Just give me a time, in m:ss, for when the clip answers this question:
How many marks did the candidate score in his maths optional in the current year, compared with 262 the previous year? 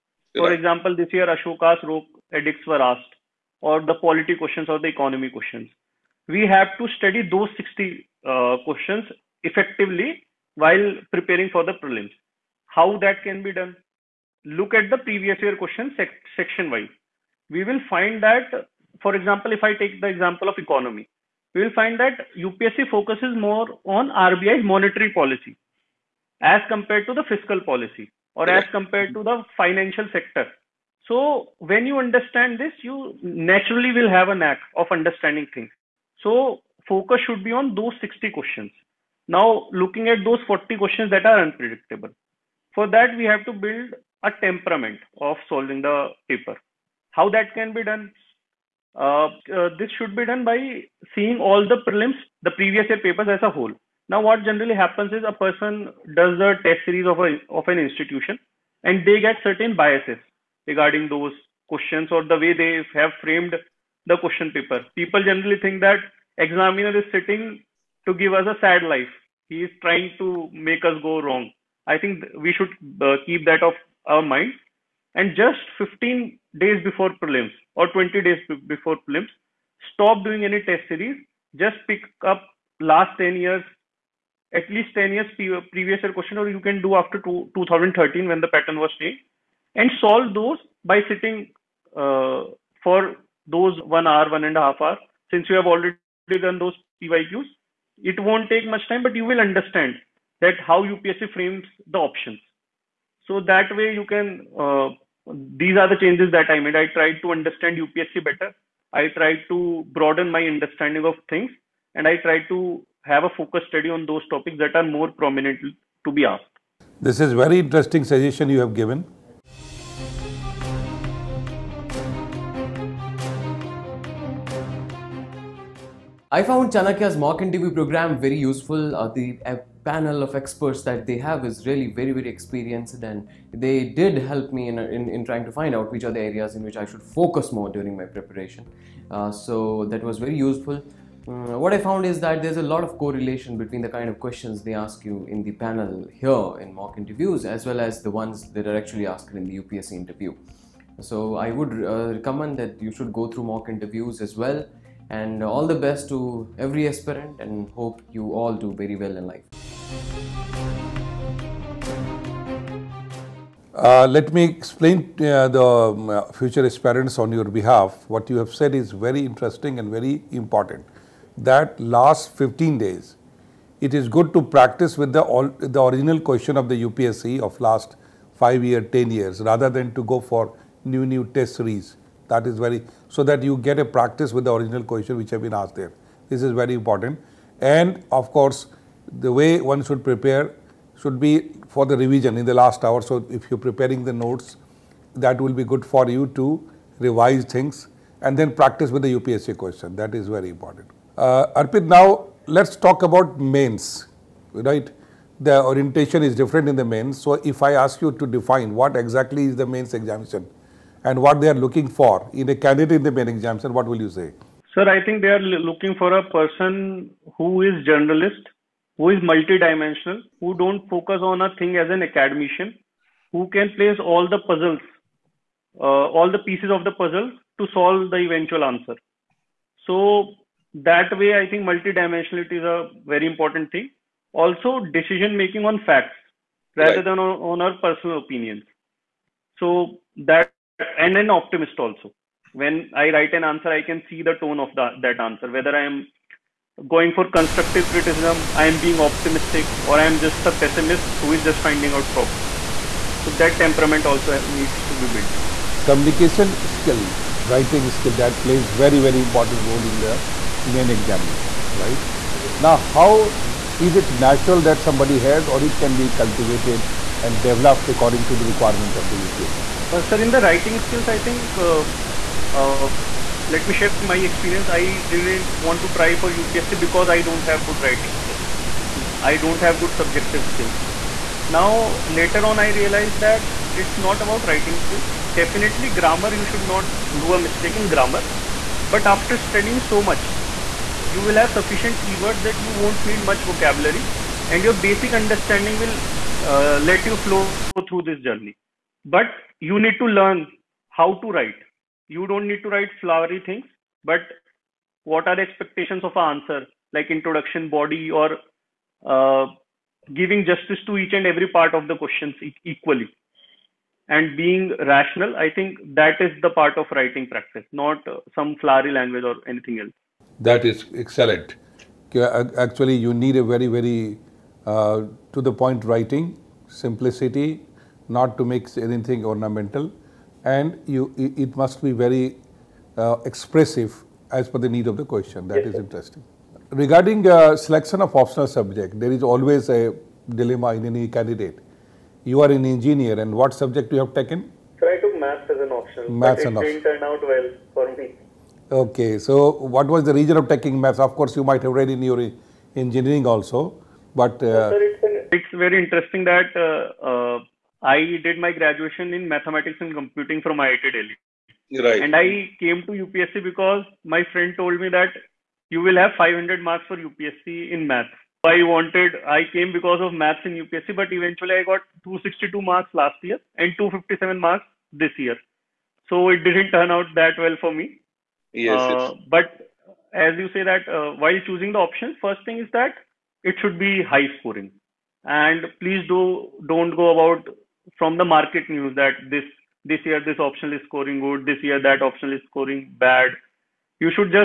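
6:13.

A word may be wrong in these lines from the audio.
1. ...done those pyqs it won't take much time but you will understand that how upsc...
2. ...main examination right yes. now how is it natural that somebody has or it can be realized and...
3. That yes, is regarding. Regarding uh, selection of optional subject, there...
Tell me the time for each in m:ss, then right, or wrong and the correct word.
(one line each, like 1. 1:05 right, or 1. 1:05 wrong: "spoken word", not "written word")
1. 1:36 right
2. 4:20 wrong: "cultivated", not "realized"
3. 5:35 wrong: "interesting", not "regarding".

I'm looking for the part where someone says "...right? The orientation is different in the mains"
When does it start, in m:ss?
3:24.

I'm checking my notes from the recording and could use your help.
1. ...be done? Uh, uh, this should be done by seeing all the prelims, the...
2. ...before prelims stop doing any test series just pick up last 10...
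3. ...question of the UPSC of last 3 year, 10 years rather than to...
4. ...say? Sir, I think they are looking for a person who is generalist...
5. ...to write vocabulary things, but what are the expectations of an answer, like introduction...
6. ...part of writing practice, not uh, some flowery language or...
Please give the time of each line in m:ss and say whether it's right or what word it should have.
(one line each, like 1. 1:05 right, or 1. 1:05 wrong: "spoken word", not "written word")
1. 0:47 right
2. 1:18 right
3. 2:56 wrong: "5", not "3"
4. 3:34 right
5. 5:02 wrong: "flowery", not "vocabulary"
6. 5:16 right.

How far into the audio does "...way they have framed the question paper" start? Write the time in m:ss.
1:02.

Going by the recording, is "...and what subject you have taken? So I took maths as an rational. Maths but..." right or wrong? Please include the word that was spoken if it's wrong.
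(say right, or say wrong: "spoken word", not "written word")
wrong: "optional", not "rational".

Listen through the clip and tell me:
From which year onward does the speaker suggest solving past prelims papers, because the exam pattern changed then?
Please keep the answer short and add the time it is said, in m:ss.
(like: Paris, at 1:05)
2013, at 1:27.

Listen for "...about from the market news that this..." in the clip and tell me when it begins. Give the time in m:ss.
6:27.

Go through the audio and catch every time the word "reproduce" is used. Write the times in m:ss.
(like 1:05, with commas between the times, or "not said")
not said.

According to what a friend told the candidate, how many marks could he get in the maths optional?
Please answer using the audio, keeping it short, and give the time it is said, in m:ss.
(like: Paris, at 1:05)
500, at 6:06.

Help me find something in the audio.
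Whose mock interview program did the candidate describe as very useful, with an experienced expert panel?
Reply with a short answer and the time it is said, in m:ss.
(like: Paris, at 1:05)
Chanakya, at 2:06.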